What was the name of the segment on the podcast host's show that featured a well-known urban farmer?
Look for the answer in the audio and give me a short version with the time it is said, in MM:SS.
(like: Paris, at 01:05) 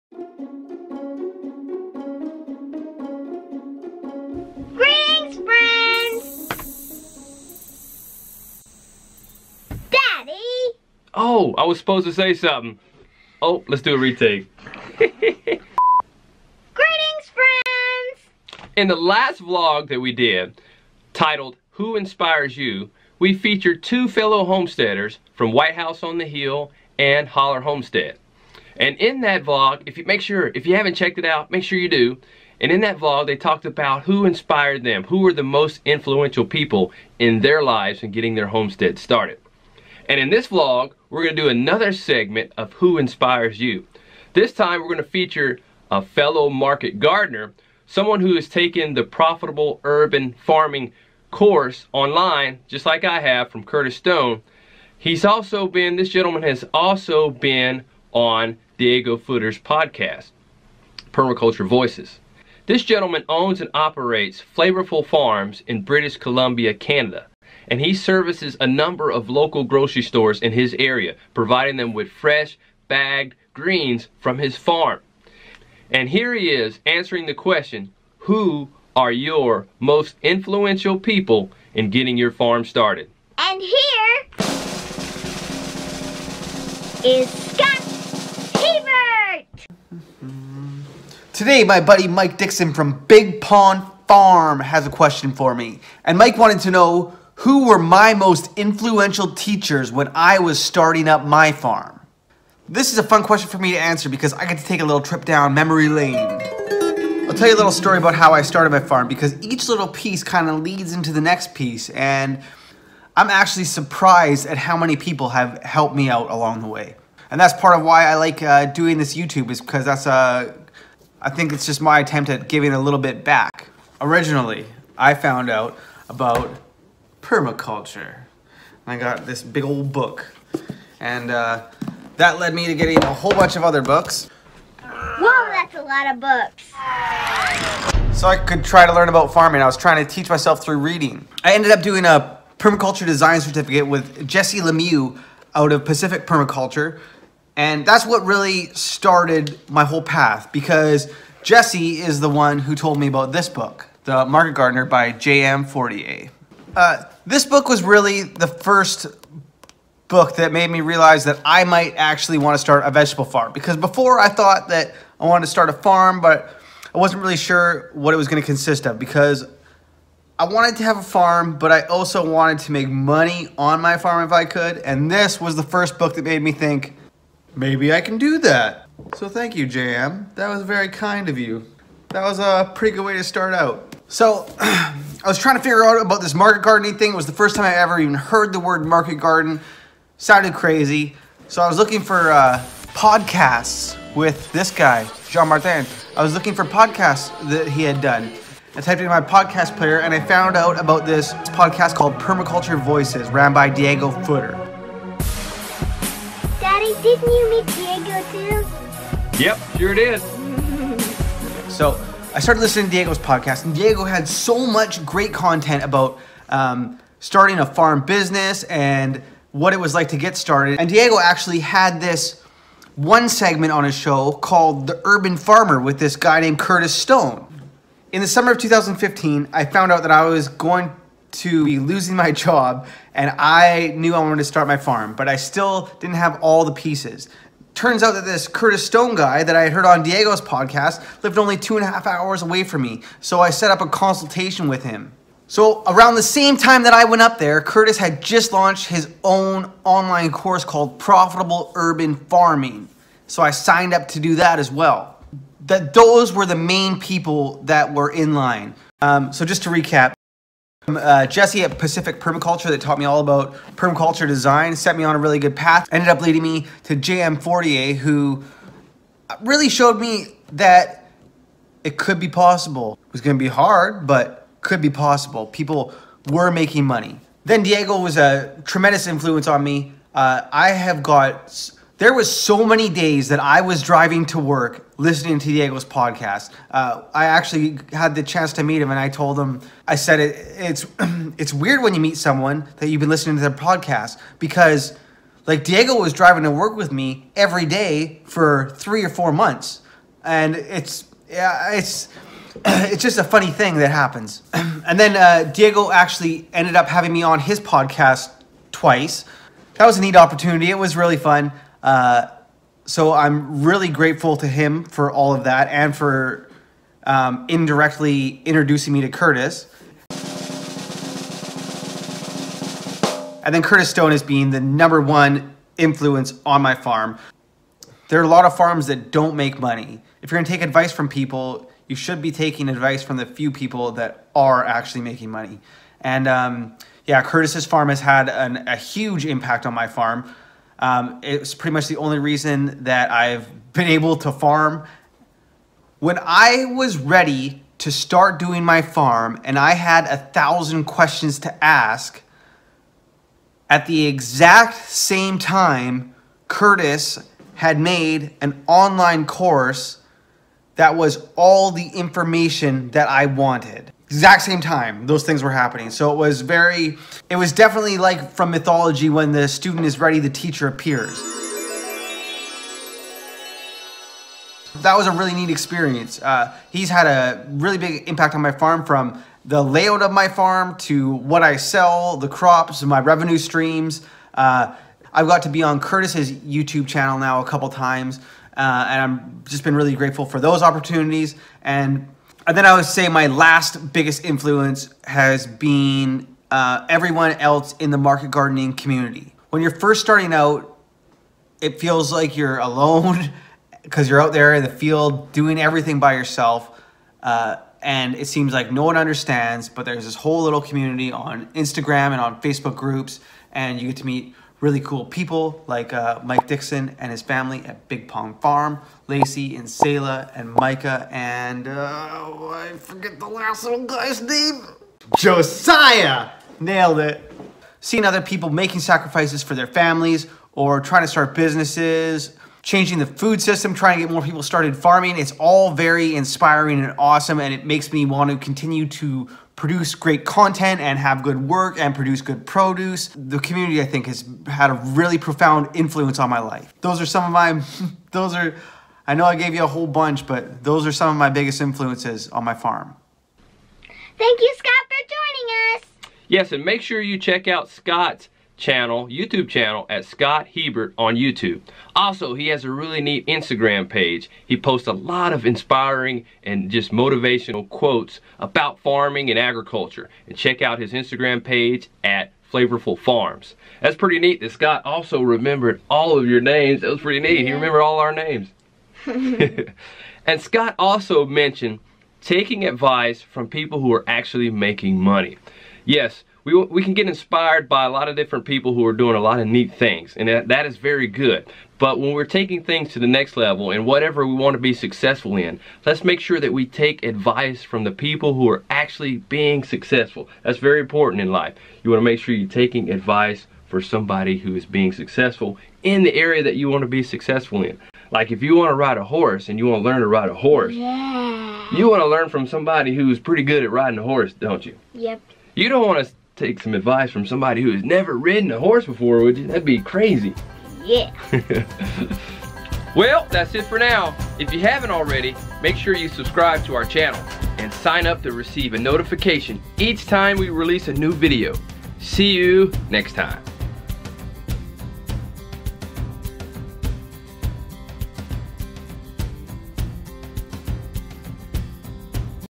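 The Urban Farmer, at 03:44.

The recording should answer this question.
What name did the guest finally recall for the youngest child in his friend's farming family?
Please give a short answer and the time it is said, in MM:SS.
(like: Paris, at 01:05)
Josiah, at 07:05.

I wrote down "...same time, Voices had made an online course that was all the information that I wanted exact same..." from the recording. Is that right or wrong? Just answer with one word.
wrong.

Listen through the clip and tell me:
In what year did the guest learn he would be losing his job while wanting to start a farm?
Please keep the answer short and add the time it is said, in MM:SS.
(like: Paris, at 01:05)
2015, at 03:48.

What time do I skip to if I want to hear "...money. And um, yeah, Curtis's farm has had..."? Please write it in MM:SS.
05:35.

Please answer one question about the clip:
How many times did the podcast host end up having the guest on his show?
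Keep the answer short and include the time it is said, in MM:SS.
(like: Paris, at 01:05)
2, at 05:08.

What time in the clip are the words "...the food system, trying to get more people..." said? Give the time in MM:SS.
07:12.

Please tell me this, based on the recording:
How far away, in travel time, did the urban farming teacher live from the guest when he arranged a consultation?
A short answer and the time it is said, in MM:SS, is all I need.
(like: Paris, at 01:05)
2.5 hours, at 04:01.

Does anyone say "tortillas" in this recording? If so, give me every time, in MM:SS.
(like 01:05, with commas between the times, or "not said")
not said.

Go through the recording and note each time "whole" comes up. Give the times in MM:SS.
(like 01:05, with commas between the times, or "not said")
02:13, 02:29, 06:50, 07:29.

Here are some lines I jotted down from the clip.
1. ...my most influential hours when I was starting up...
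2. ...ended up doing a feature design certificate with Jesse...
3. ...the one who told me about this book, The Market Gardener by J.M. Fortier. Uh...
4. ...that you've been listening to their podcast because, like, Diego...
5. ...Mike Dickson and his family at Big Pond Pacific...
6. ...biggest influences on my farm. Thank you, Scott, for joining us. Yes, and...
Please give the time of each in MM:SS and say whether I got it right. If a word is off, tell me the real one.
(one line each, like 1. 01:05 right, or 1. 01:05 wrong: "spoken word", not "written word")
1. 01:37 wrong: "teachers", not "hours"
2. 02:21 wrong: "permaculture", not "feature"
3. 02:32 right
4. 04:52 right
5. 06:56 wrong: "Farm", not "Pacific"
6. 07:31 right.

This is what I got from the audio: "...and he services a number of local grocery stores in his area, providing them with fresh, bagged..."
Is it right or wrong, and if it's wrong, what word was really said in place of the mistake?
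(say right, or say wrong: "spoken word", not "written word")
right.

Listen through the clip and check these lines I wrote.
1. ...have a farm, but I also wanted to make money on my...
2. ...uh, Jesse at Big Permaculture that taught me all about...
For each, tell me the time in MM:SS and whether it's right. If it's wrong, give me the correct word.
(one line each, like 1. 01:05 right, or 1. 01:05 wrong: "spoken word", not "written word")
1. 02:50 right
2. 04:20 wrong: "Pacific", not "Big".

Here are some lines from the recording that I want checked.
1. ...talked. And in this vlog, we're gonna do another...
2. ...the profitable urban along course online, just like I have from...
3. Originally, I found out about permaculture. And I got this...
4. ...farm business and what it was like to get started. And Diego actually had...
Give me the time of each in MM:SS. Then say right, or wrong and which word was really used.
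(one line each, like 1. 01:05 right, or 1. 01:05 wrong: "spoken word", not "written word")
1. 00:38 wrong: "started", not "talked"
2. 00:48 wrong: "farming", not "along"
3. 02:03 right
4. 03:37 right.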